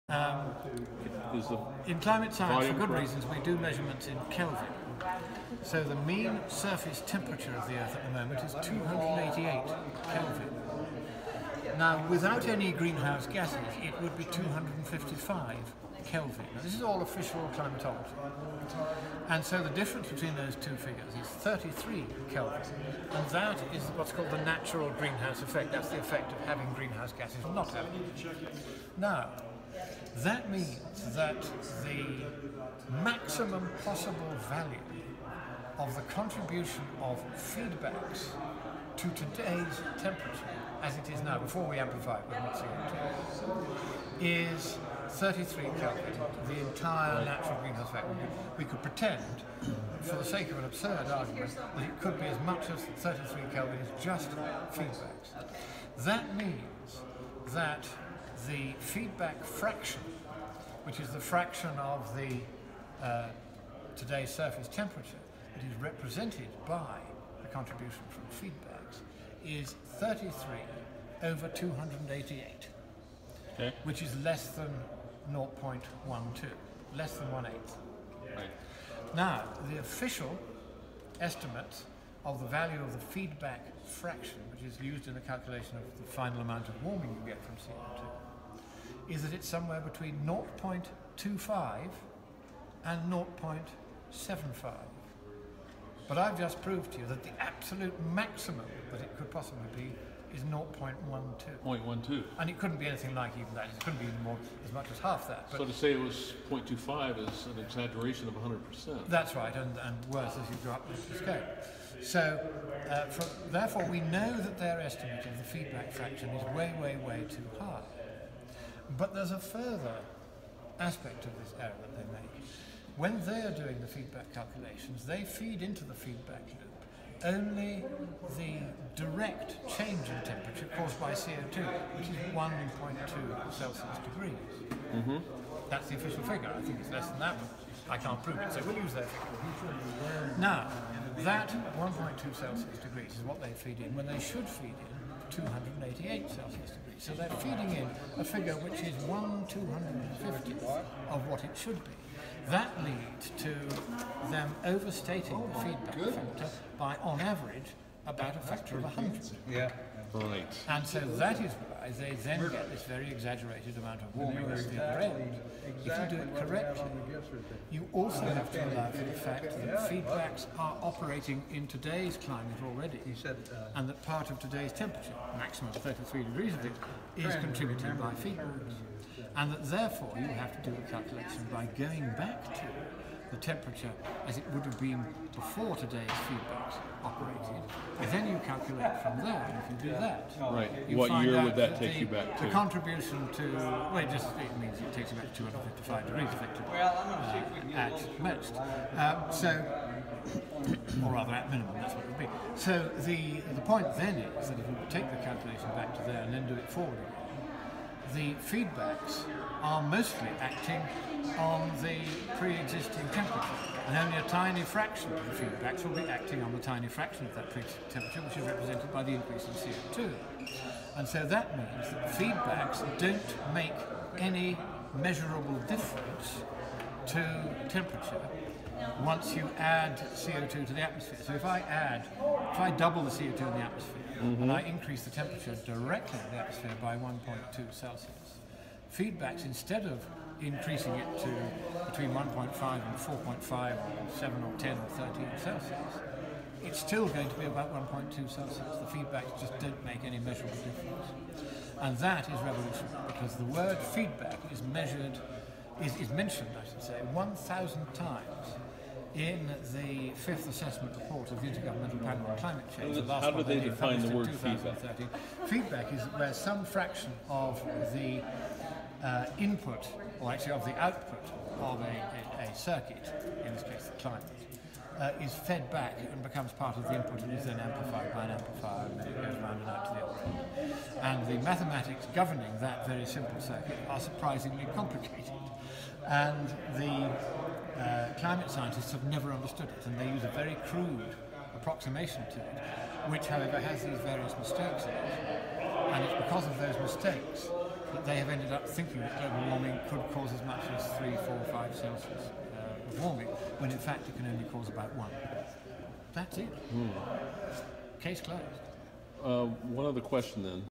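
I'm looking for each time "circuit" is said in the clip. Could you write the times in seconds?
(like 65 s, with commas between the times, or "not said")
272 s, 283 s.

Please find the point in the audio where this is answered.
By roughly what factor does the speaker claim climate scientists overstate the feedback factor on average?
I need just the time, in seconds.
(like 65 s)
158 s.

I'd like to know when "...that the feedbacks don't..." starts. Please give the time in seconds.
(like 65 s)
221 s.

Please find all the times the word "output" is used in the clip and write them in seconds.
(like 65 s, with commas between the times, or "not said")
270 s.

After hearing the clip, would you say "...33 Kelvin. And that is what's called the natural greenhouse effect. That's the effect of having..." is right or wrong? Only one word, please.
right.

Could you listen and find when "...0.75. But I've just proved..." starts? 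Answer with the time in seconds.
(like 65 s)
93 s.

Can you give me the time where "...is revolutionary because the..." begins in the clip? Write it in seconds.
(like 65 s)
252 s.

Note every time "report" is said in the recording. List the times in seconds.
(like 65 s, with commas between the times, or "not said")
260 s.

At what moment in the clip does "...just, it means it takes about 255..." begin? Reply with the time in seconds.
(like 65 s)
194 s.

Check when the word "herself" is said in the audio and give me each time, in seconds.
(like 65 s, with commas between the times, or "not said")
not said.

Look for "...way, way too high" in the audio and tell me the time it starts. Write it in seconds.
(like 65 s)
116 s.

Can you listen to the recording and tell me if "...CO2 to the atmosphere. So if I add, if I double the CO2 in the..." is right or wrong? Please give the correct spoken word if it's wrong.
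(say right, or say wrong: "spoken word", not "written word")
right.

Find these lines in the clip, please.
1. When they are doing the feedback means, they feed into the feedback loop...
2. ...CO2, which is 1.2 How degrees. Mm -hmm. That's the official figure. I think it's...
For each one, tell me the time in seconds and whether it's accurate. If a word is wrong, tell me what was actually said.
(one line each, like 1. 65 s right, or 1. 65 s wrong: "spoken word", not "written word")
1. 122 s wrong: "calculations", not "means"
2. 131 s wrong: "Celsius", not "How".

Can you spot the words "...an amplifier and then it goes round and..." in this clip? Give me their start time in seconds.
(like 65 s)
278 s.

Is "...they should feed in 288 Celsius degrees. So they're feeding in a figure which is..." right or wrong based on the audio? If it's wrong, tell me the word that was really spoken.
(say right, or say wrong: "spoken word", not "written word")
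right.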